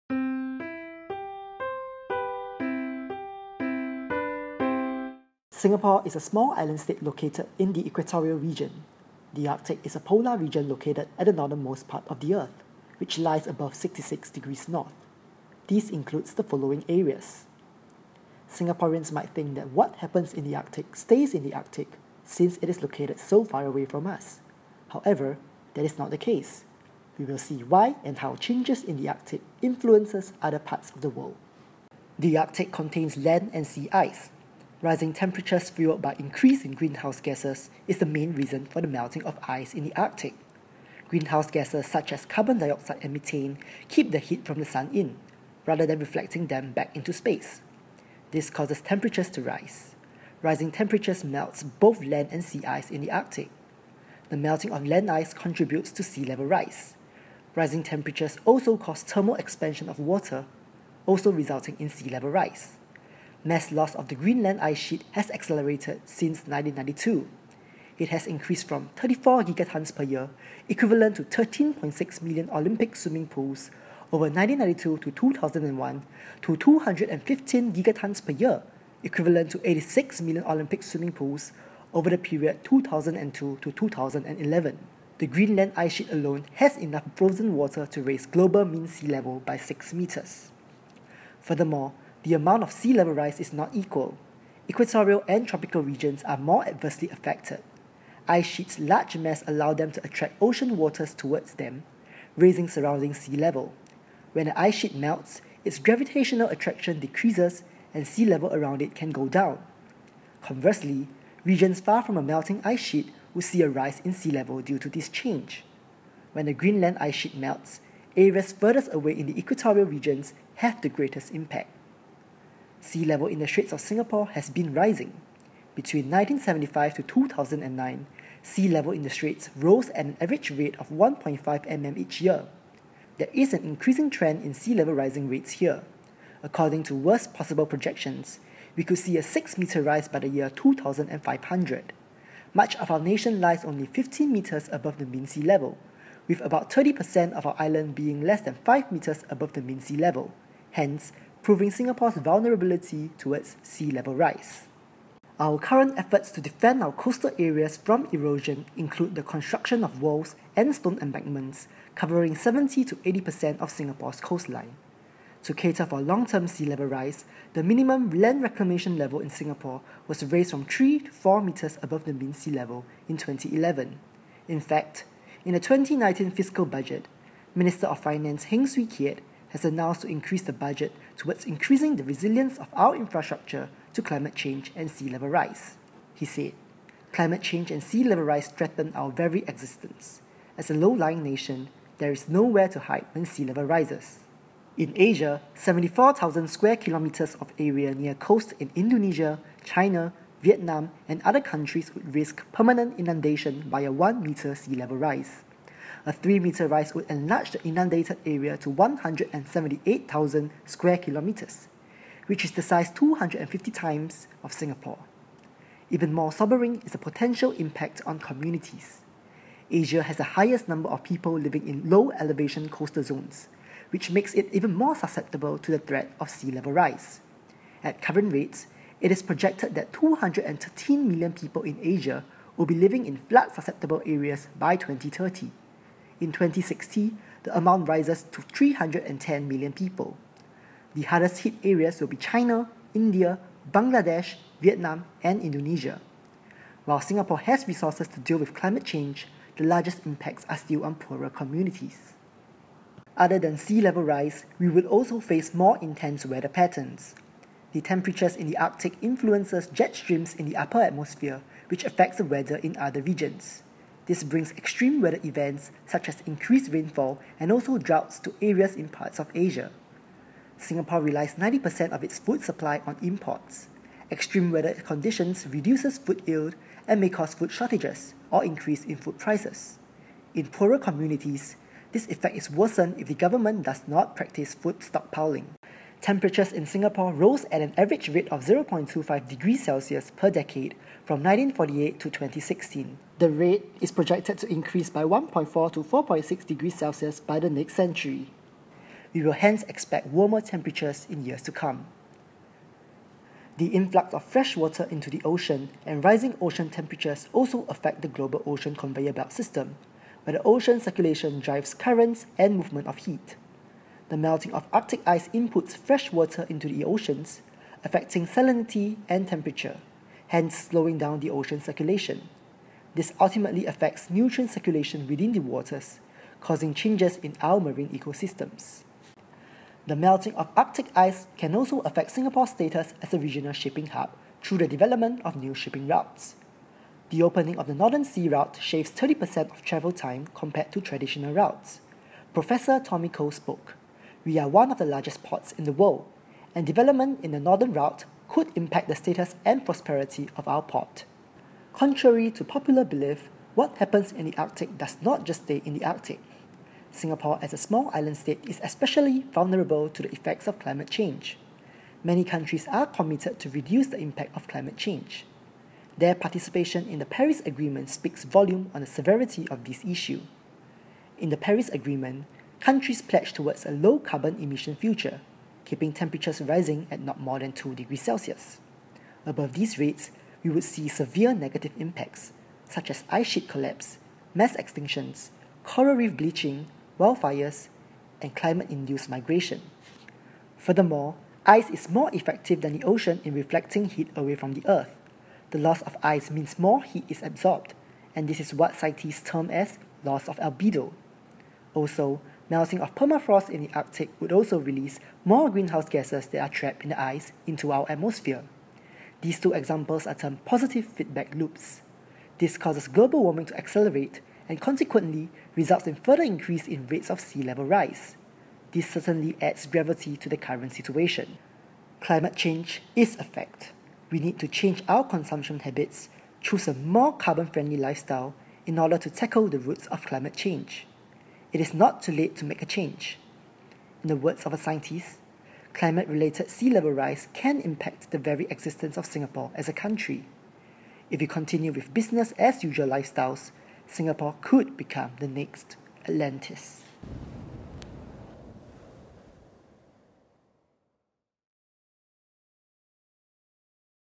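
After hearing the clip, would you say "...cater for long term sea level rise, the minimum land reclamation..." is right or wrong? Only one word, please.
right.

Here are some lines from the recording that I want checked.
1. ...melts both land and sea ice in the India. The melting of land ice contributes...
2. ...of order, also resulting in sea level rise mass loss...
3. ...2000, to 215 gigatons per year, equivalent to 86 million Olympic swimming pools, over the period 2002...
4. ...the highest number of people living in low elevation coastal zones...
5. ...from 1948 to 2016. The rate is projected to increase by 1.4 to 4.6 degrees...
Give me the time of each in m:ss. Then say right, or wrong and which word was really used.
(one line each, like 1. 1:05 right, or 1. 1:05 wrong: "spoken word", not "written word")
1. 0:51 wrong: "Arctic", not "India"
2. 0:59 wrong: "water", not "order"
3. 1:15 wrong: "2001", not "2000"
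4. 3:40 right
5. 4:51 right.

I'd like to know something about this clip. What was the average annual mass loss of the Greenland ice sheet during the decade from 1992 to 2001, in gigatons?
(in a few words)
34 gigatons per year.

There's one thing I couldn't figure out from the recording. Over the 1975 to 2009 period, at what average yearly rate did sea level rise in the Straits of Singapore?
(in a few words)
1.5 mm.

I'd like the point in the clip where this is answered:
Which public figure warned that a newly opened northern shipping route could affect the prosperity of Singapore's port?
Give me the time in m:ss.
5:42.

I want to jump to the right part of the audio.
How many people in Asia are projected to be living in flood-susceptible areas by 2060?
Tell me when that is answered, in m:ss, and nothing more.
3:58.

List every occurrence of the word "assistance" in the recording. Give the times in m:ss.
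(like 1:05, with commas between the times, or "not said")
not said.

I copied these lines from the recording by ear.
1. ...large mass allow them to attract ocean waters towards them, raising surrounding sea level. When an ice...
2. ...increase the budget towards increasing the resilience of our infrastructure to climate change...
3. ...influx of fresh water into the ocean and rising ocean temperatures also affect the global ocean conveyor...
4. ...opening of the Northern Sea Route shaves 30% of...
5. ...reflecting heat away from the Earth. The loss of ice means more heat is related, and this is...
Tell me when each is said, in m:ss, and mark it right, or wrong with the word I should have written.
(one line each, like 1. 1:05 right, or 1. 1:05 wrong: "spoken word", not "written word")
1. 1:38 right
2. 3:00 right
3. 5:03 right
4. 5:37 right
5. 6:33 wrong: "absorbed", not "related".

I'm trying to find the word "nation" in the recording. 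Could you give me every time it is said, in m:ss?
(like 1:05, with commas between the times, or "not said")
2:22, 3:11.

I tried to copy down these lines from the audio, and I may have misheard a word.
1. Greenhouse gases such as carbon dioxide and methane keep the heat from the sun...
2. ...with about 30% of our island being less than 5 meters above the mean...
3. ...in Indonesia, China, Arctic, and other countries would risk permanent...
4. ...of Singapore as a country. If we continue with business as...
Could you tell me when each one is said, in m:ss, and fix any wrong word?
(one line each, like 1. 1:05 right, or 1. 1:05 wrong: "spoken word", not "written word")
1. 0:41 right
2. 2:26 right
3. 3:18 wrong: "Vietnam", not "Arctic"
4. 7:18 right.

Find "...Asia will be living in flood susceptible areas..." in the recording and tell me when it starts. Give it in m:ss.
3:51.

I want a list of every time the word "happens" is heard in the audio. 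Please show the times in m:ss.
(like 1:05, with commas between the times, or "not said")
0:19, 5:53.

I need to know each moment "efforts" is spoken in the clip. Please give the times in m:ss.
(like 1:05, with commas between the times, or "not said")
2:35.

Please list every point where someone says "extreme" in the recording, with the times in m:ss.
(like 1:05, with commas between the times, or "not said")
4:24, 4:34.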